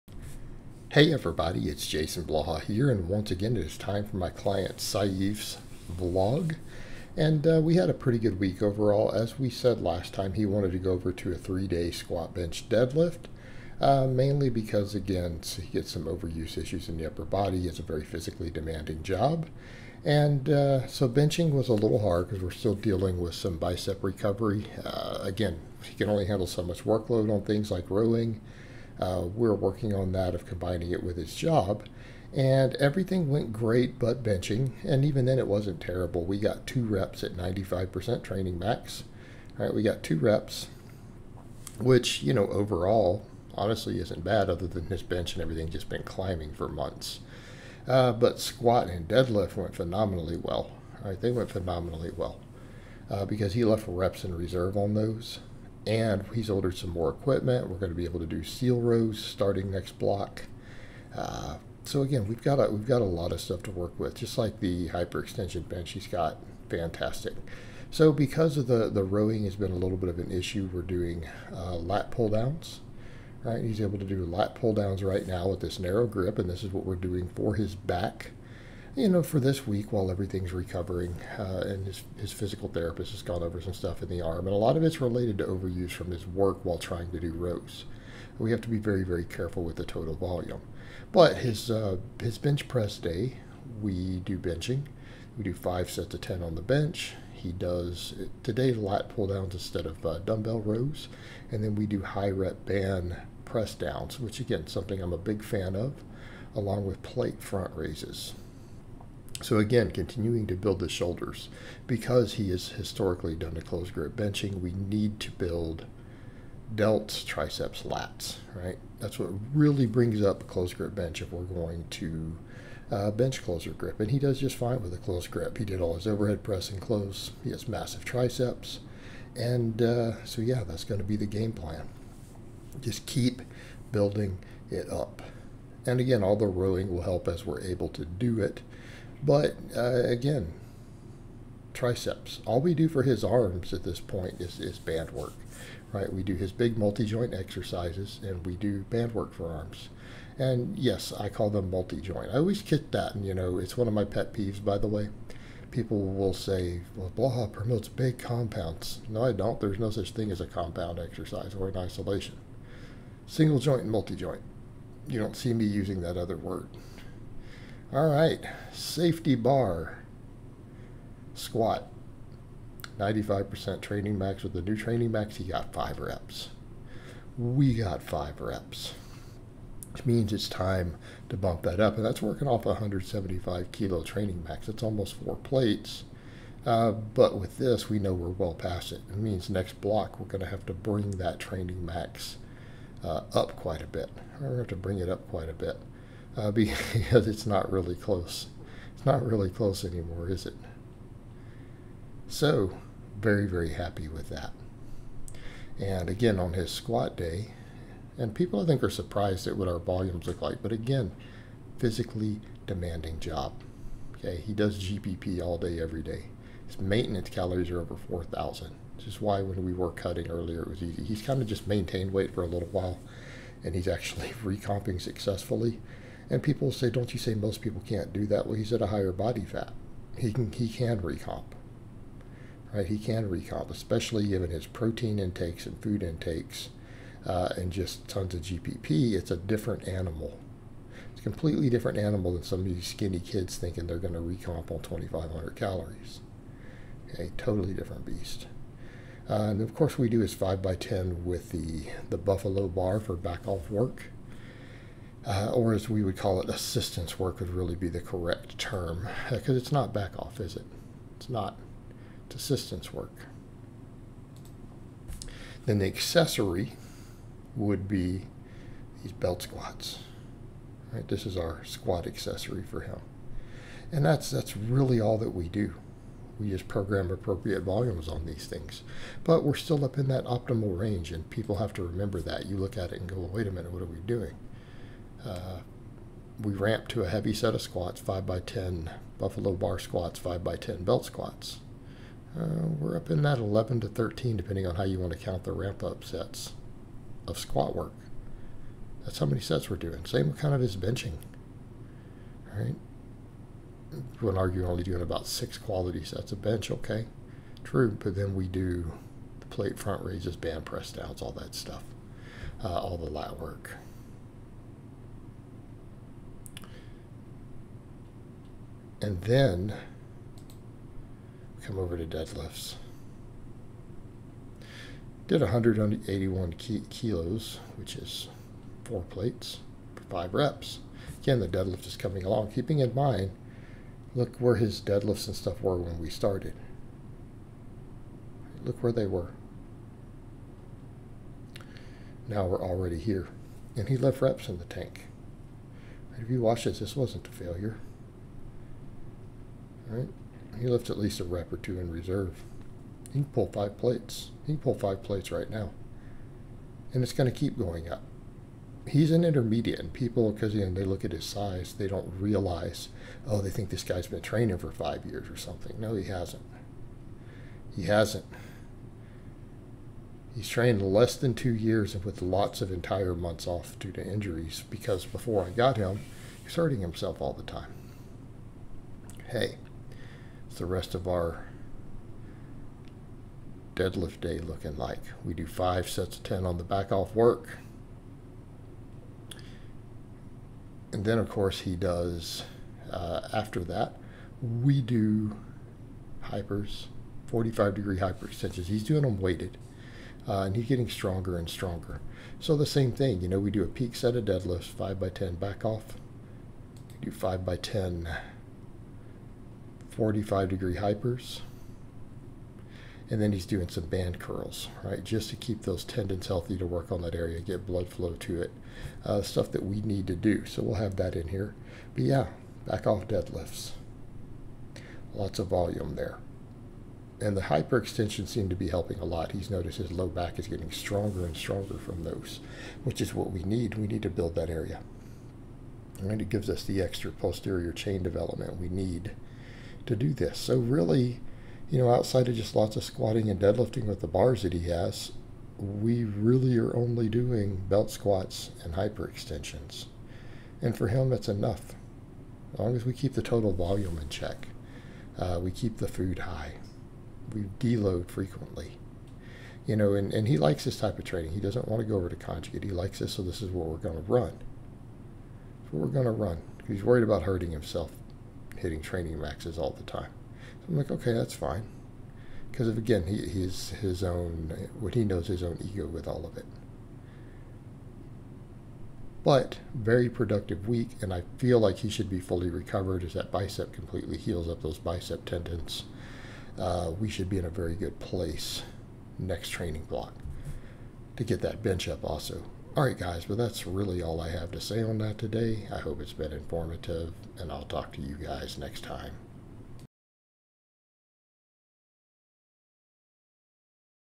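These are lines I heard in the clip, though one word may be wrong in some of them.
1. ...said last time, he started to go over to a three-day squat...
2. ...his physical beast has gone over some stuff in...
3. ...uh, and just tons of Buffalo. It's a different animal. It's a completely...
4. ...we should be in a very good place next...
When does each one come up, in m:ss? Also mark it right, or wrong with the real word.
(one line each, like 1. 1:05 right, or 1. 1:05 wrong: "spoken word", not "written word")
1. 0:09 wrong: "wanted", not "started"
2. 1:22 wrong: "therapist", not "beast"
3. 3:57 wrong: "GPP", not "Buffalo"
4. 8:06 right.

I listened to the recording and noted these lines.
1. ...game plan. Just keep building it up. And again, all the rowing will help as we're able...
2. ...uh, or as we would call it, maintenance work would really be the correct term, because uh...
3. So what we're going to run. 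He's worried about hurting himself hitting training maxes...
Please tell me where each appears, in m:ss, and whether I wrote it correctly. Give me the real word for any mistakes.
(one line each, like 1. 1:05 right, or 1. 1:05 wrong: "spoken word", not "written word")
1. 2:11 right
2. 4:15 wrong: "assistance", not "maintenance"
3. 7:45 right.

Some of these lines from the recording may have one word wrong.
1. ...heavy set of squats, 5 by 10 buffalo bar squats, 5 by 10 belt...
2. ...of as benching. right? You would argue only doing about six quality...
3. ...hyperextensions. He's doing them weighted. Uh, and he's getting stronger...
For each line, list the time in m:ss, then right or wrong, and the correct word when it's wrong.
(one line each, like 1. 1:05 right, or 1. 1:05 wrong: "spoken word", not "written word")
1. 4:47 right
2. 5:00 right
3. 6:37 right.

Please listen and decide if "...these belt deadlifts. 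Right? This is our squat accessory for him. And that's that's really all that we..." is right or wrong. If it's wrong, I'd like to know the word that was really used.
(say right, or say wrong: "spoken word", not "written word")
wrong: "squats", not "deadlifts".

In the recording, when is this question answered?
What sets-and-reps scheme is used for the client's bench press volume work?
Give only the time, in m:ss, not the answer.
1:35.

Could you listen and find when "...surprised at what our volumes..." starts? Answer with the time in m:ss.
3:28.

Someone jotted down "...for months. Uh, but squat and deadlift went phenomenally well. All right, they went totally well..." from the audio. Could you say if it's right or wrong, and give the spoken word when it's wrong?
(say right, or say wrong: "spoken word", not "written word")
wrong: "phenomenally", not "totally".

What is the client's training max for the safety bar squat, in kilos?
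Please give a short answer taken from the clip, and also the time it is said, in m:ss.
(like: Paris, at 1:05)
175 kilos, at 3:02.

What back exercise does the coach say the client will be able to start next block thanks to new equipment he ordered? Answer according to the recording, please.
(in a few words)
seal rows.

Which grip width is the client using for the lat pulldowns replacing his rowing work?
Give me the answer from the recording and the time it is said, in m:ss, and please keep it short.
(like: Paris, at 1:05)
narrow grip, at 1:15.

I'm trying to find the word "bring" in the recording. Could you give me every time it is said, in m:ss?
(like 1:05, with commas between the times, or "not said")
1:59, 3:10, 3:14.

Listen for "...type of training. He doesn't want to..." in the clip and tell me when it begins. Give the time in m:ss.
7:40.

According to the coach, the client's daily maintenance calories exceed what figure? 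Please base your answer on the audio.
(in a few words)
4,000.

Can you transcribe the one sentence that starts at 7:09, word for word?
He's noticed his low back is getting stronger and stronger from those, which is what we need.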